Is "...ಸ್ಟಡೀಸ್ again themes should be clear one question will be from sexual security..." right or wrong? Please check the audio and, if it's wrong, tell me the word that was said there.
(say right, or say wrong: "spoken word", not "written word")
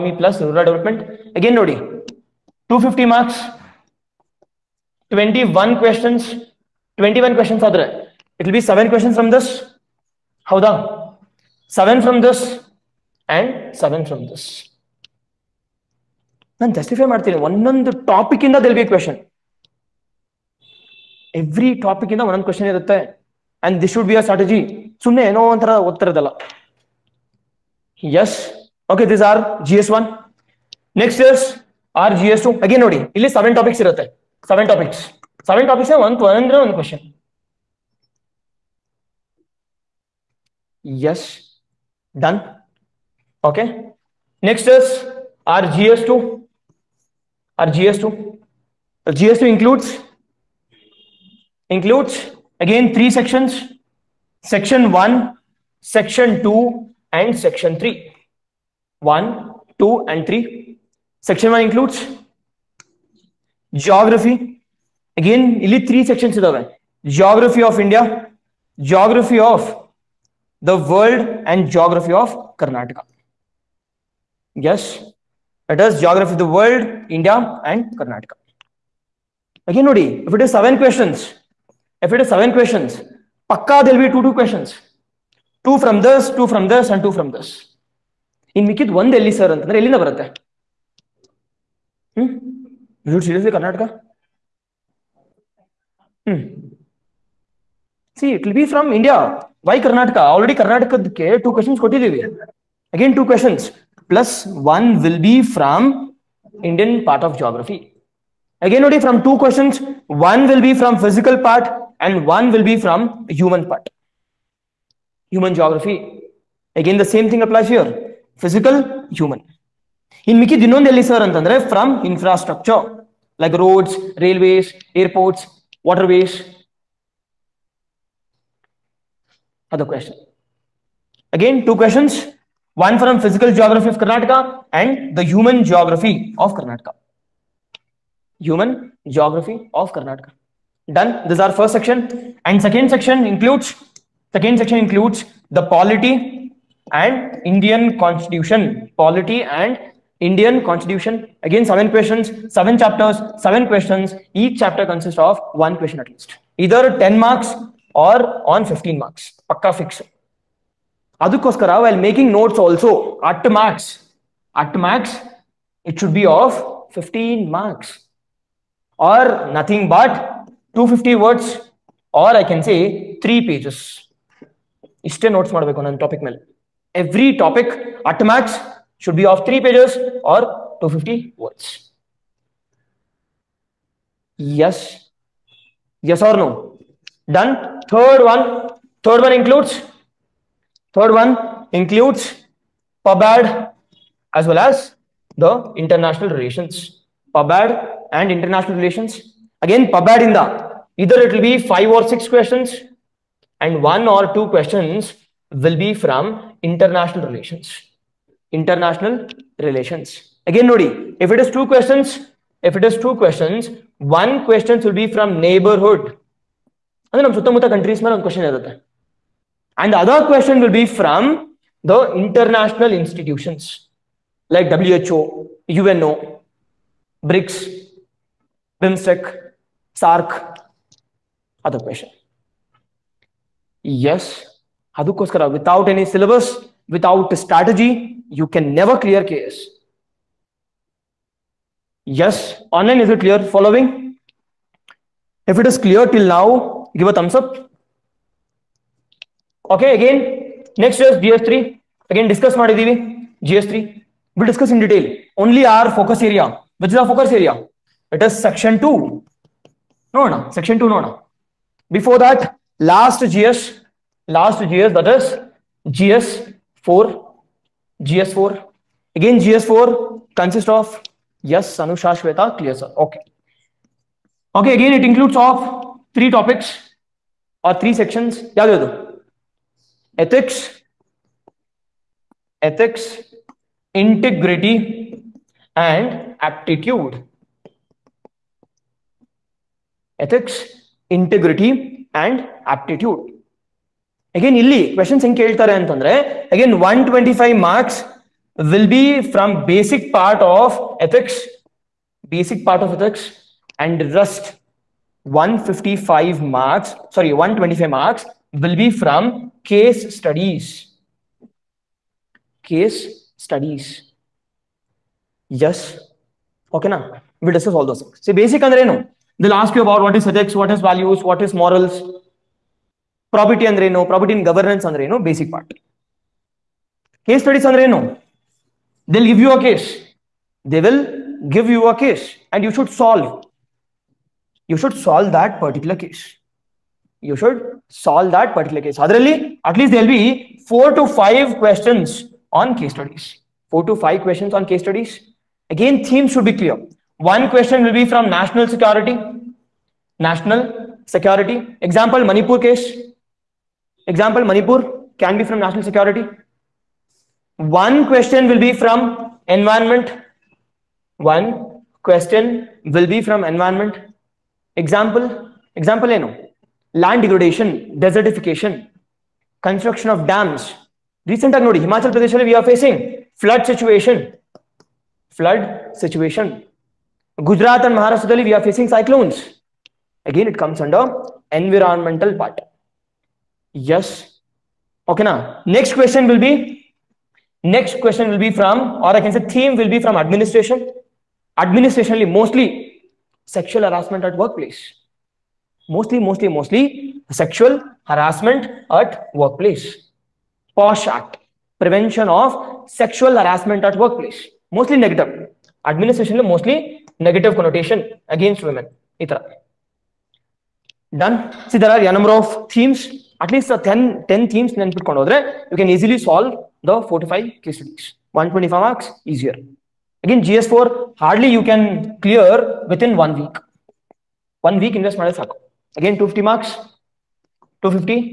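wrong: "national", not "sexual".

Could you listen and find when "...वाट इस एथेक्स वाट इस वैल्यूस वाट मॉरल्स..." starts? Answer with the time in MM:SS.
05:20.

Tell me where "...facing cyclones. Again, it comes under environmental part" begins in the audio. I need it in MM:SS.
06:18.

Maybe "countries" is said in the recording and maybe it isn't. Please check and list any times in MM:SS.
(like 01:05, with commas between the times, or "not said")
03:37.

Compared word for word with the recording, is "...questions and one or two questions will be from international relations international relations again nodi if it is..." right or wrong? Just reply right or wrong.
right.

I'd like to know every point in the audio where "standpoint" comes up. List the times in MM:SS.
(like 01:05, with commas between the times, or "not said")
not said.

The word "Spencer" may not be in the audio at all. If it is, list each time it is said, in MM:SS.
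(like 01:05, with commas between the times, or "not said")
not said.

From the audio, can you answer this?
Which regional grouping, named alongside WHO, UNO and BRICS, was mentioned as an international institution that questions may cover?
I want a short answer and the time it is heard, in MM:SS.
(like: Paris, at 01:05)
BIMSTEC, at 03:48.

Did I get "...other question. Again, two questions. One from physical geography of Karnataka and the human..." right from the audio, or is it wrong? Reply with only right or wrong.
right.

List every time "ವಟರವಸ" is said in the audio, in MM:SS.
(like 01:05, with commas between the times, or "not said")
02:05.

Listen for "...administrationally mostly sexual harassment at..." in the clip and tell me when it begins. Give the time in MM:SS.
06:31.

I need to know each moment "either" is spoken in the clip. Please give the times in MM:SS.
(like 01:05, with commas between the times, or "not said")
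02:36, 03:20.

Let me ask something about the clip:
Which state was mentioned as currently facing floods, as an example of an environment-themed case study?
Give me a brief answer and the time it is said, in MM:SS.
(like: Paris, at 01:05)
Himachal Pradesh, at 06:11.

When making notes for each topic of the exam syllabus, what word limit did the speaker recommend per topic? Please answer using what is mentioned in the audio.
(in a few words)
250 words.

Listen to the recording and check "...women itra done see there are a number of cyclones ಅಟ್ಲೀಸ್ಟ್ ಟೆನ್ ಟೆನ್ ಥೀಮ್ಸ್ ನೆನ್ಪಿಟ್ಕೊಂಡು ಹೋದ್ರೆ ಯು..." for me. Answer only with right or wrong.
wrong.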